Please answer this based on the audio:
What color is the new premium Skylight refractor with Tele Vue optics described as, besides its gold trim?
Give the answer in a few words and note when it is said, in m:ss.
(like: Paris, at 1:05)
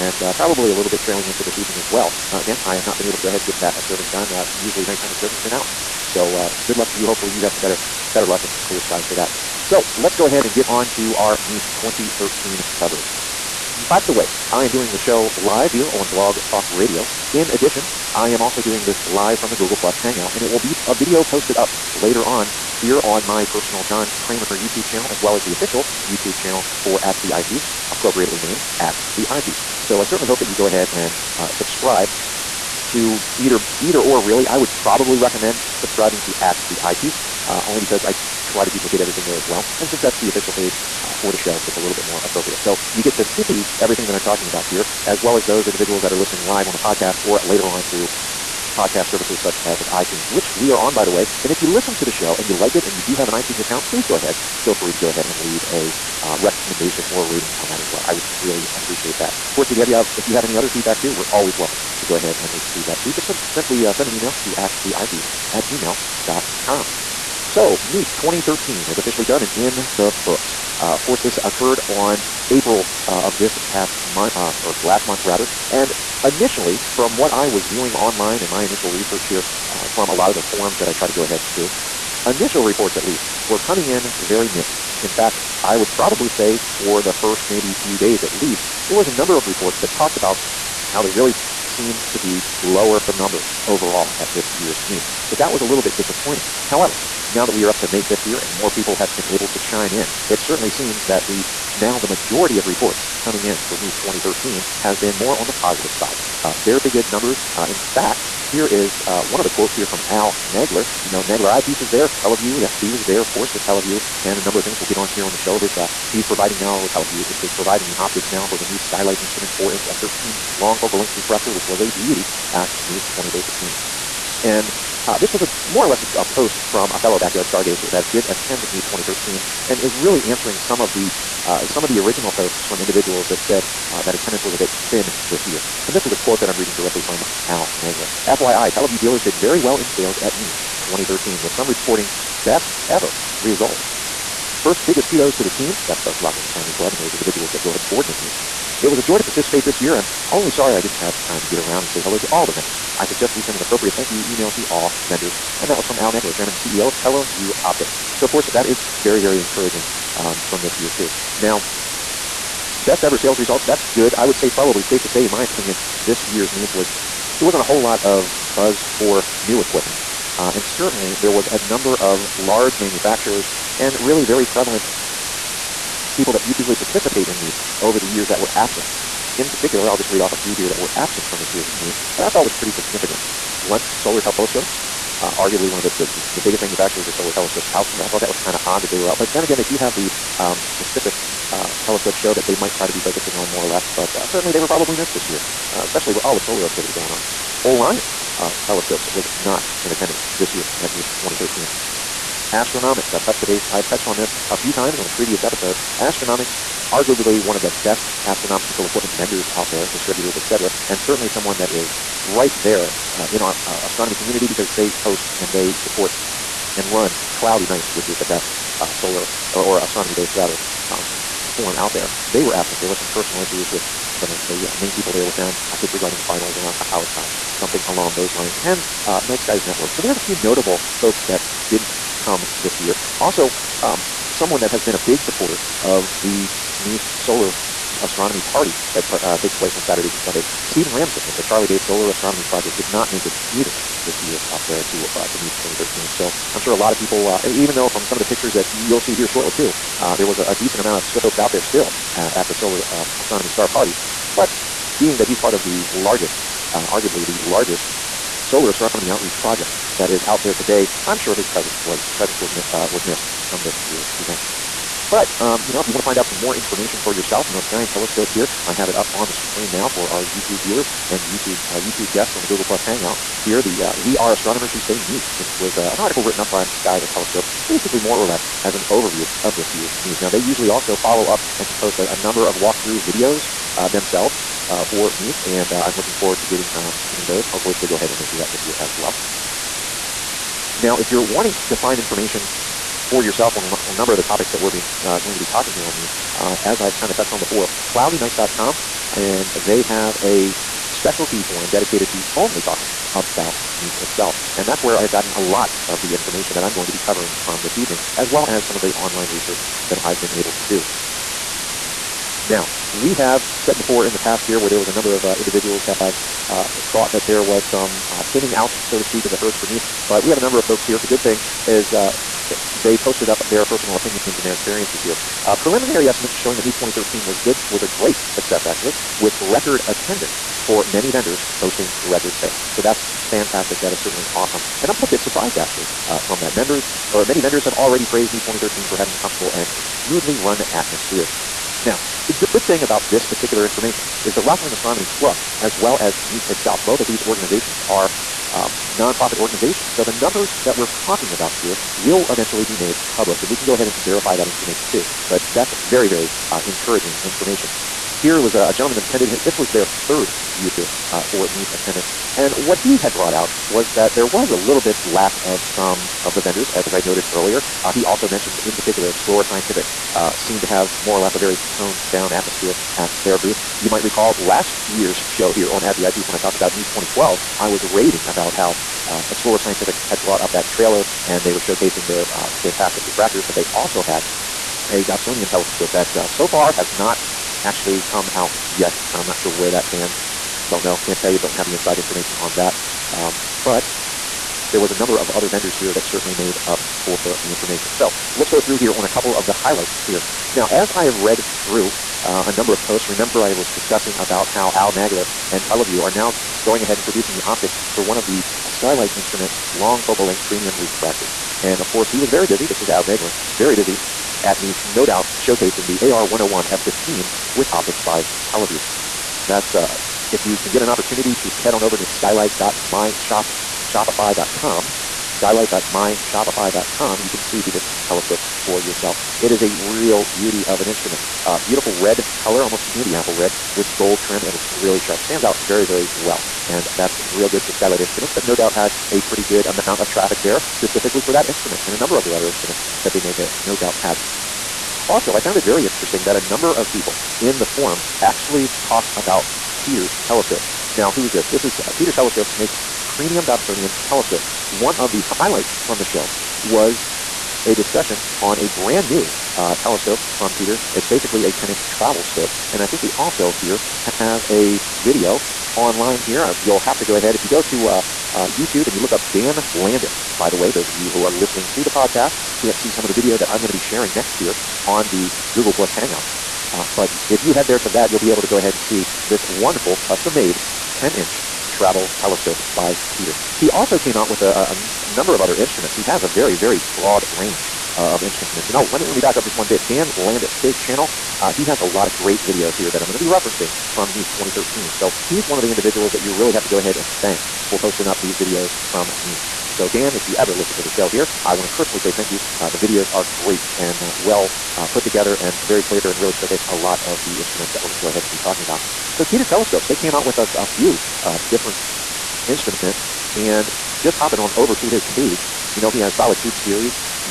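candy apple red, at 7:12.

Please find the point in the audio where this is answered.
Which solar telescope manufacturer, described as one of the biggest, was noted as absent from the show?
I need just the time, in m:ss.
3:03.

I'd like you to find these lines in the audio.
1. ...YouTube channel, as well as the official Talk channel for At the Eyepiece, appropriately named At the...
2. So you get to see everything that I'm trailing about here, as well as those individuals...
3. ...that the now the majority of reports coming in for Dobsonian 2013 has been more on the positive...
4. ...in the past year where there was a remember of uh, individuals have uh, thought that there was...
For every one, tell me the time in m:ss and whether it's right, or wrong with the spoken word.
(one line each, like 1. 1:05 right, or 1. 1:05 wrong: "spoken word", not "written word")
1. 0:24 wrong: "YouTube", not "Talk"
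2. 0:42 wrong: "talking", not "trailing"
3. 1:41 wrong: "NEAF", not "Dobsonian"
4. 5:14 wrong: "number", not "remember".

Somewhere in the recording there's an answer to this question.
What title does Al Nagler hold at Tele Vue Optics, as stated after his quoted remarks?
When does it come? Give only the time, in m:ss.
2:36.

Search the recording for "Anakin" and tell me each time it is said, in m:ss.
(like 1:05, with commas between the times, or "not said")
not said.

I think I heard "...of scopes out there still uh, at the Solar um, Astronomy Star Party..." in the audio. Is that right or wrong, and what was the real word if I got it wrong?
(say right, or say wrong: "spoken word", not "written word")
right.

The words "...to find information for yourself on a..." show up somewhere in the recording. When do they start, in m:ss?
4:51.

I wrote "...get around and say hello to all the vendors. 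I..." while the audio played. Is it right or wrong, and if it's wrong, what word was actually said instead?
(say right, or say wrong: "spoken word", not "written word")
right.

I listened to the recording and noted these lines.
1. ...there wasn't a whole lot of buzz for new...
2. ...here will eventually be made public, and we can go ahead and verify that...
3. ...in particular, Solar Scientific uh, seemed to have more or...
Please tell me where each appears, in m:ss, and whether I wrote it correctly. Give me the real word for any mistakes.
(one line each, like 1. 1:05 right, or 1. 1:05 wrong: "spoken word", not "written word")
1. 2:47 right
2. 5:51 right
3. 6:08 wrong: "Explore", not "Solar".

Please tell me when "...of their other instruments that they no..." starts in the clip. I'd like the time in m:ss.
7:22.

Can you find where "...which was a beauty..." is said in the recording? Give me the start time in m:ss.
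2:01.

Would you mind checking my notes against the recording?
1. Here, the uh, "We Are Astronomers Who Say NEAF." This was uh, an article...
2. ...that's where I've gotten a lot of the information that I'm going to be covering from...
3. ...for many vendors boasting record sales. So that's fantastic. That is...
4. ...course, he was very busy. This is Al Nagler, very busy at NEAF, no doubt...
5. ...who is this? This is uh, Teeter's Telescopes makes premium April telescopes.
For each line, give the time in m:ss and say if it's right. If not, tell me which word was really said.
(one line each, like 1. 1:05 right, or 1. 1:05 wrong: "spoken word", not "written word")
1. 4:33 right
2. 5:04 right
3. 5:30 right
4. 6:51 right
5. 7:31 wrong: "Dobsonian", not "April".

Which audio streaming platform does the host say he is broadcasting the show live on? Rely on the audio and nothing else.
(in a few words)
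Blog Talk Radio.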